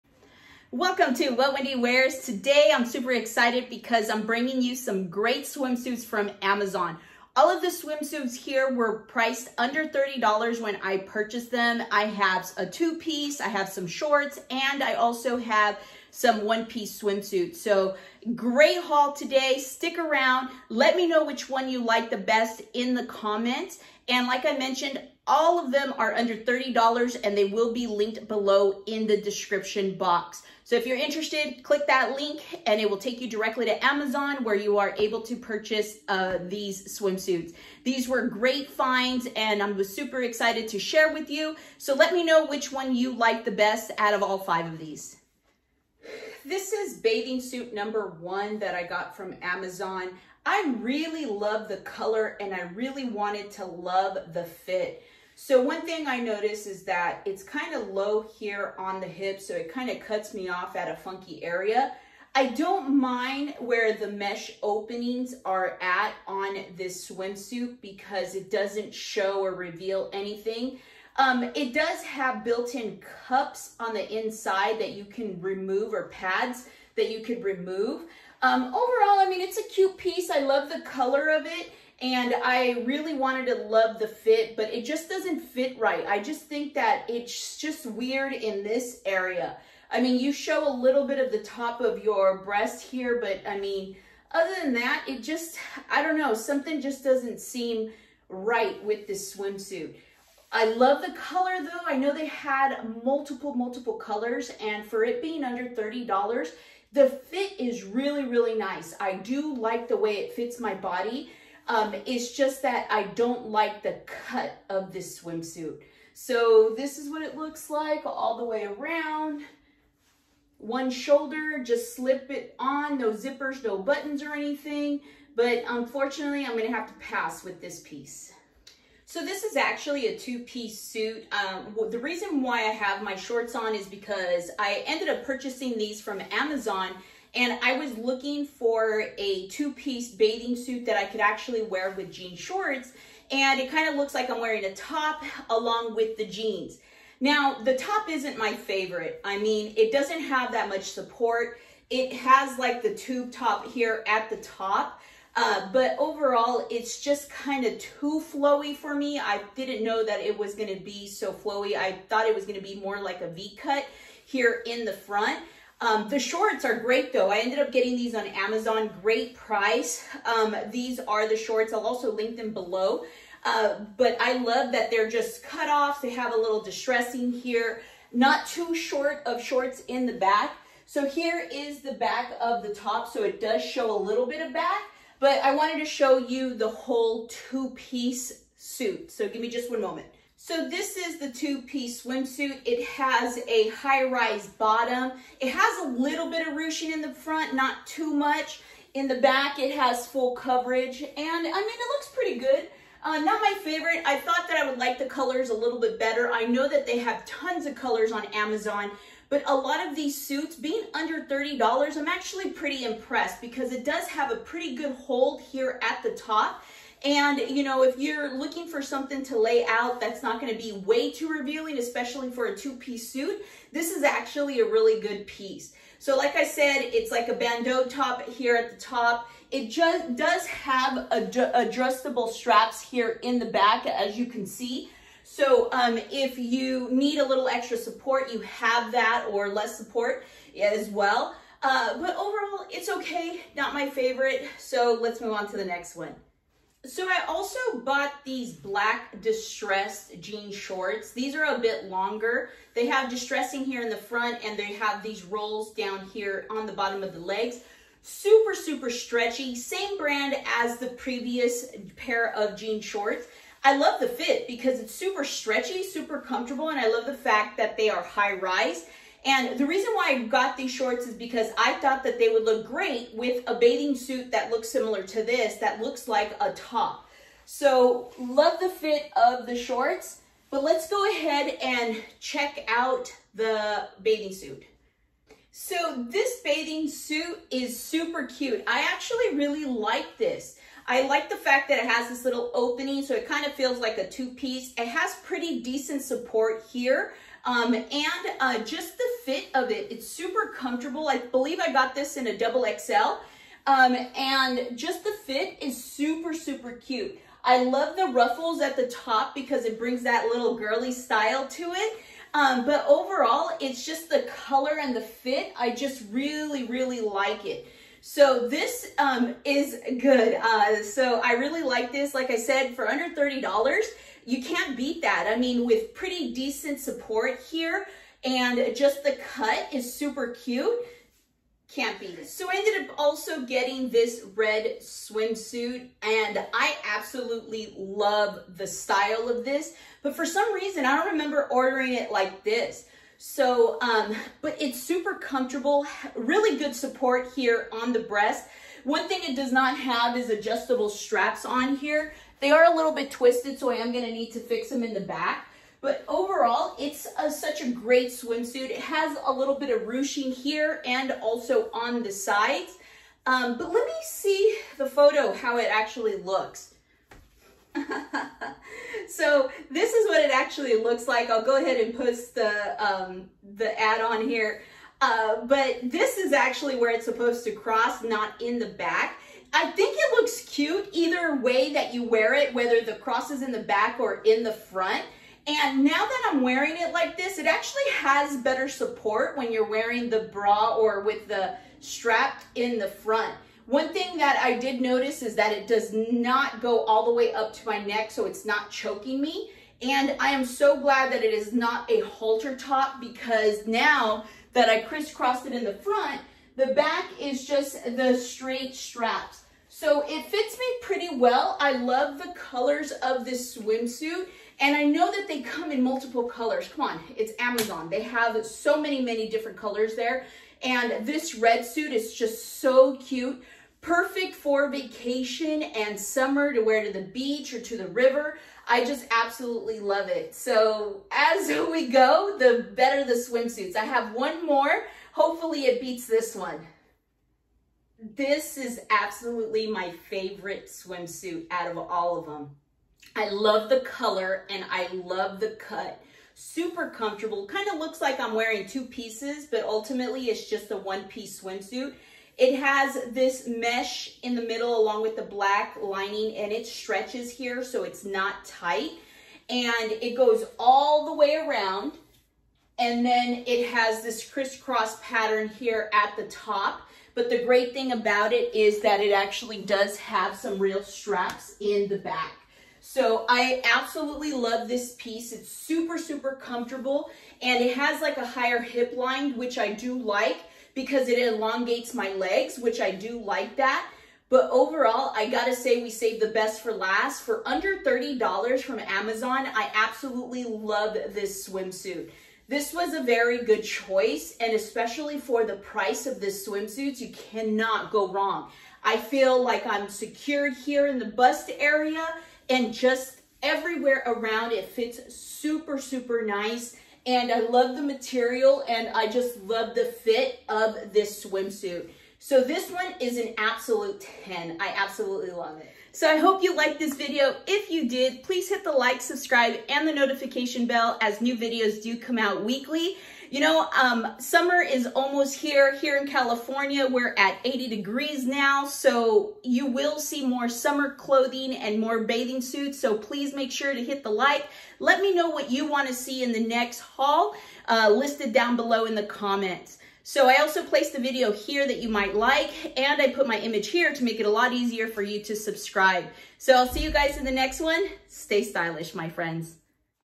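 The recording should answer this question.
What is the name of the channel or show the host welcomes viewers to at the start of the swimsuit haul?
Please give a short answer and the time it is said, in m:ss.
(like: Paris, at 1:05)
What Wendy Wears, at 0:01.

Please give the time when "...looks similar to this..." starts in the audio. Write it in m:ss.
4:34.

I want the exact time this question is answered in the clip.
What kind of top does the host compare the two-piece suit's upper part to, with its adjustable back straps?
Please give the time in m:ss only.
3:47.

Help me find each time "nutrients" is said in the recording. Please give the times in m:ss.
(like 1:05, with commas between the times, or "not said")
not said.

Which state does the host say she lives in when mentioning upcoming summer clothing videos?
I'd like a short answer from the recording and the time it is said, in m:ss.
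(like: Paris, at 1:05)
California, at 8:46.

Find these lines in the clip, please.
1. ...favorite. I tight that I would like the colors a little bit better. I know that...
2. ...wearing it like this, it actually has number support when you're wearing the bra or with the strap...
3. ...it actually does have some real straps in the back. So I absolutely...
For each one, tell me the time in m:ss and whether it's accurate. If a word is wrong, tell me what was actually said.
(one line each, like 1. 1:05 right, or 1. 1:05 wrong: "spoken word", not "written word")
1. 3:23 wrong: "thought", not "tight"
2. 6:26 wrong: "better", not "number"
3. 7:49 right.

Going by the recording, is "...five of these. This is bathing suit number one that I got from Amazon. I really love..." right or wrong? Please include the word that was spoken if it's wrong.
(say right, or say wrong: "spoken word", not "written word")
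right.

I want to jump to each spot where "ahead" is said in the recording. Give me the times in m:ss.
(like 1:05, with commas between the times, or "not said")
4:41, 6:11.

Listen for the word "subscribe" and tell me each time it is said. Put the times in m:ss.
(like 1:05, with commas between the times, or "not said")
8:39, 9:05.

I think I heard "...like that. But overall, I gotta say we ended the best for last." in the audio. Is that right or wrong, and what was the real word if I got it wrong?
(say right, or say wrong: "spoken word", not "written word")
wrong: "saved", not "ended".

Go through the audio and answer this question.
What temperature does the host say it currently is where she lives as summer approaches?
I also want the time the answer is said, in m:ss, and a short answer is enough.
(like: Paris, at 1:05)
80 degrees, at 8:47.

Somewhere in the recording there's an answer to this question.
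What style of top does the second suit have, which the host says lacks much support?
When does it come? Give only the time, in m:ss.
2:32.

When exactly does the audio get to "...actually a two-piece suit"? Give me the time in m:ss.
2:09.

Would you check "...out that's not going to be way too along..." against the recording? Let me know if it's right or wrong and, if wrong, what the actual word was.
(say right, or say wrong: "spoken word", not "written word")
wrong: "revealing", not "along".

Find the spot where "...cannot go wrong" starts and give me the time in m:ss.
8:17.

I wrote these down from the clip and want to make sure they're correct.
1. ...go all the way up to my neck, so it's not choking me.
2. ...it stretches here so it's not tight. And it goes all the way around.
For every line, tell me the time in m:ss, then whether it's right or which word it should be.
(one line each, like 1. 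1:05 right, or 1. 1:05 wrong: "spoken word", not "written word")
1. 6:36 right
2. 7:36 right.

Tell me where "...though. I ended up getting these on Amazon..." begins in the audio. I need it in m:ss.
2:47.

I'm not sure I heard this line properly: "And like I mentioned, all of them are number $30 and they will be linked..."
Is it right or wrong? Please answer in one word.
wrong.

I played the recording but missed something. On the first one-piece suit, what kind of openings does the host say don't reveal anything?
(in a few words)
Mesh openings.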